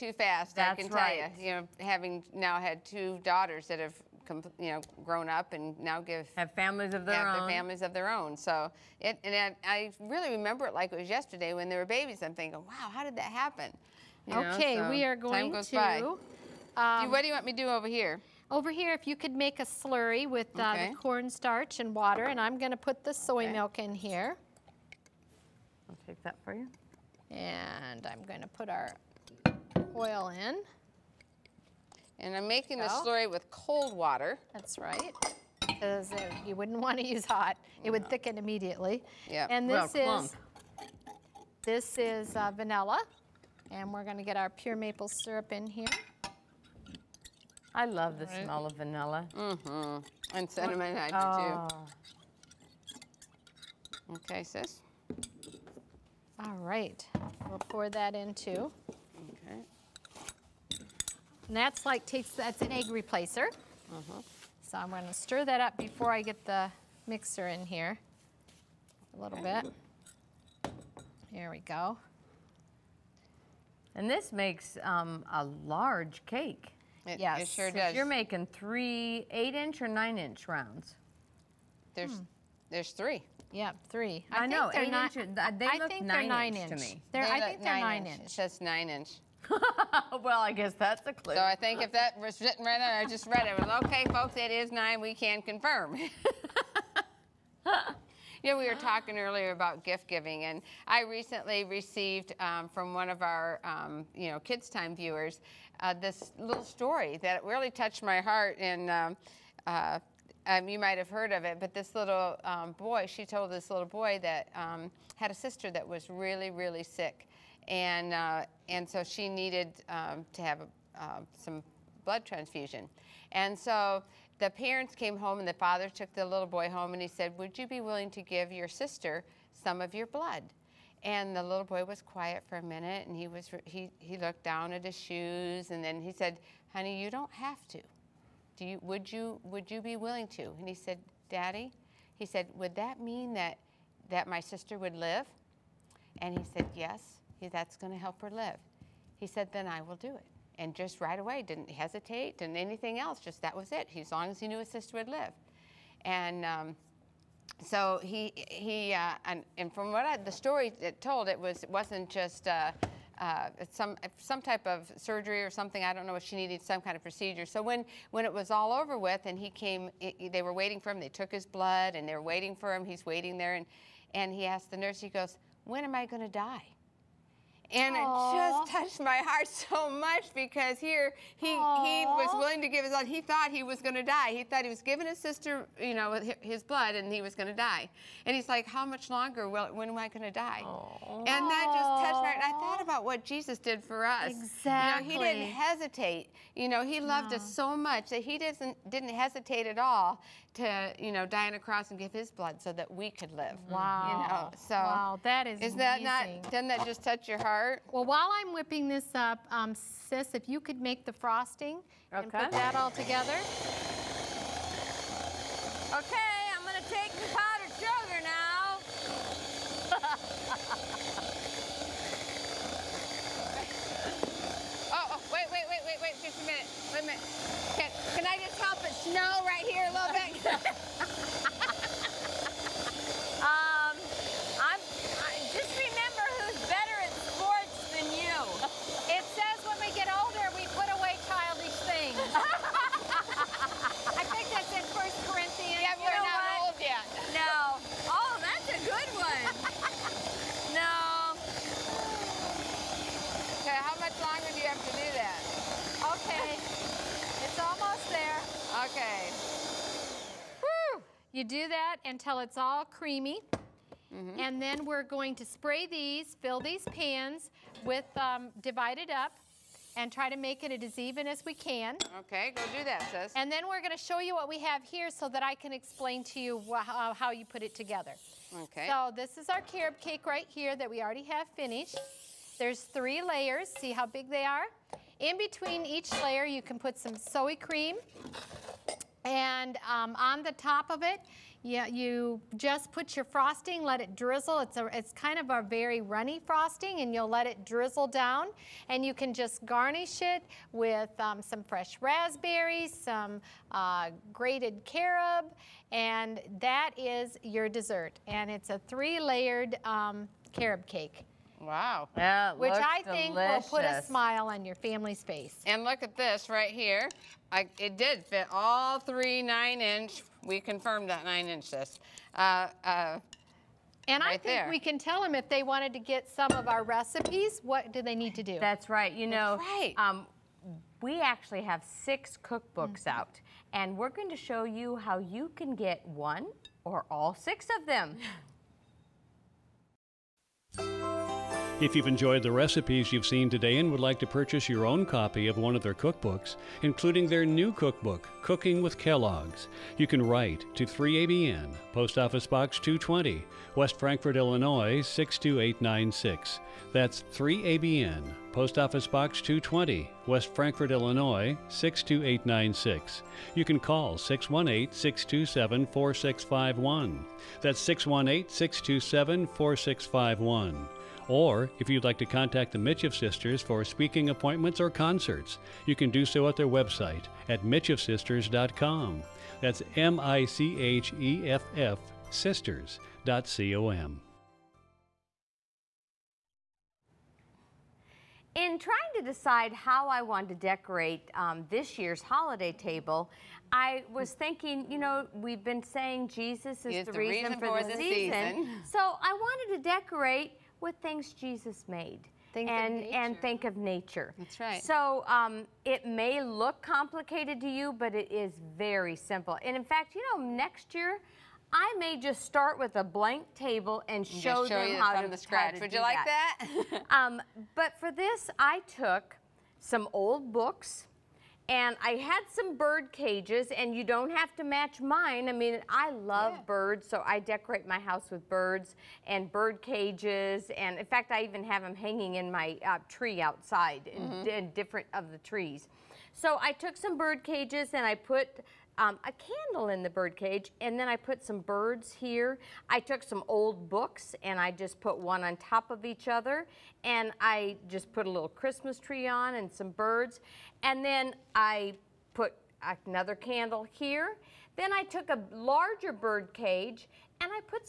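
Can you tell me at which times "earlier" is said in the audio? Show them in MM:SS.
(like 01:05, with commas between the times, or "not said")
01:39.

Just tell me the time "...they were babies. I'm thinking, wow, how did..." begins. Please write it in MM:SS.
00:11.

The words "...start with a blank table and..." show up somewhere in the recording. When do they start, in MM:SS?
06:52.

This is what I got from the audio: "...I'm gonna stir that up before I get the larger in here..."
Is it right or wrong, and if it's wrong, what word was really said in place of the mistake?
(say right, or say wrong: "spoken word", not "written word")
wrong: "mixer", not "larger".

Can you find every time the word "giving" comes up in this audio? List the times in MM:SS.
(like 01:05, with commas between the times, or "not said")
01:40, 03:04.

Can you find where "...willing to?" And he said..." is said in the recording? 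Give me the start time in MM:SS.
02:19.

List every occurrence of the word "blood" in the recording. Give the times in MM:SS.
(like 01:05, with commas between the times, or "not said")
02:02, 02:10, 02:51, 03:06, 03:22.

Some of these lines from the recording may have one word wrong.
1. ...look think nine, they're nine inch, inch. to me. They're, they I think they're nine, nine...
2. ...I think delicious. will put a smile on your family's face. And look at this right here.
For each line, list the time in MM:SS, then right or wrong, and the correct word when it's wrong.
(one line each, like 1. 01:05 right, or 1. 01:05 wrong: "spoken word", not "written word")
1. 01:25 right
2. 05:12 right.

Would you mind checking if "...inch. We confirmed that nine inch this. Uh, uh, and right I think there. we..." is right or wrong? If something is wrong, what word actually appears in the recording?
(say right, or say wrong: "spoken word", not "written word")
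right.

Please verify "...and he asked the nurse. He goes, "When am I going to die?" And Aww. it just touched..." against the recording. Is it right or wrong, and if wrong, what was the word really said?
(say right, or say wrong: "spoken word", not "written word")
right.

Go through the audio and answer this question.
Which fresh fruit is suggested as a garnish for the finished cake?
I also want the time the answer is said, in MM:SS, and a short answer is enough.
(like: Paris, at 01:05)
Raspberries, at 05:01.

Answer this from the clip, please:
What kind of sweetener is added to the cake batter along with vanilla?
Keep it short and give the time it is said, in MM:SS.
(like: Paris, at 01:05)
Pure maple syrup, at 00:44.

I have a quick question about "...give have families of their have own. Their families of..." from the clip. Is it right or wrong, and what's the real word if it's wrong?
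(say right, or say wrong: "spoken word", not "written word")
right.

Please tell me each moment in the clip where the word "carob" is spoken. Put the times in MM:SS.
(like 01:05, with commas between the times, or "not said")
04:39, 05:04, 05:10.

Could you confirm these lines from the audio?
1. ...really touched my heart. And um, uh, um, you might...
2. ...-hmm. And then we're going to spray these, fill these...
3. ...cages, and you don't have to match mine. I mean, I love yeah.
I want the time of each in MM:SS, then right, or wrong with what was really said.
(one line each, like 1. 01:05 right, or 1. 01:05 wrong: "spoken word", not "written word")
1. 01:47 right
2. 04:24 right
3. 07:03 right.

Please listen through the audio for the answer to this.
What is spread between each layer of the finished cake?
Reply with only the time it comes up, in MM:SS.
04:47.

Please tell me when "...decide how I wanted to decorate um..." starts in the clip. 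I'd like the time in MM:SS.
06:29.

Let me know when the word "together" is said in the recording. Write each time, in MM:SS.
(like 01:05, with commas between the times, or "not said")
03:32, 04:37.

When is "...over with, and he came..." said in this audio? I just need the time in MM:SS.
02:48.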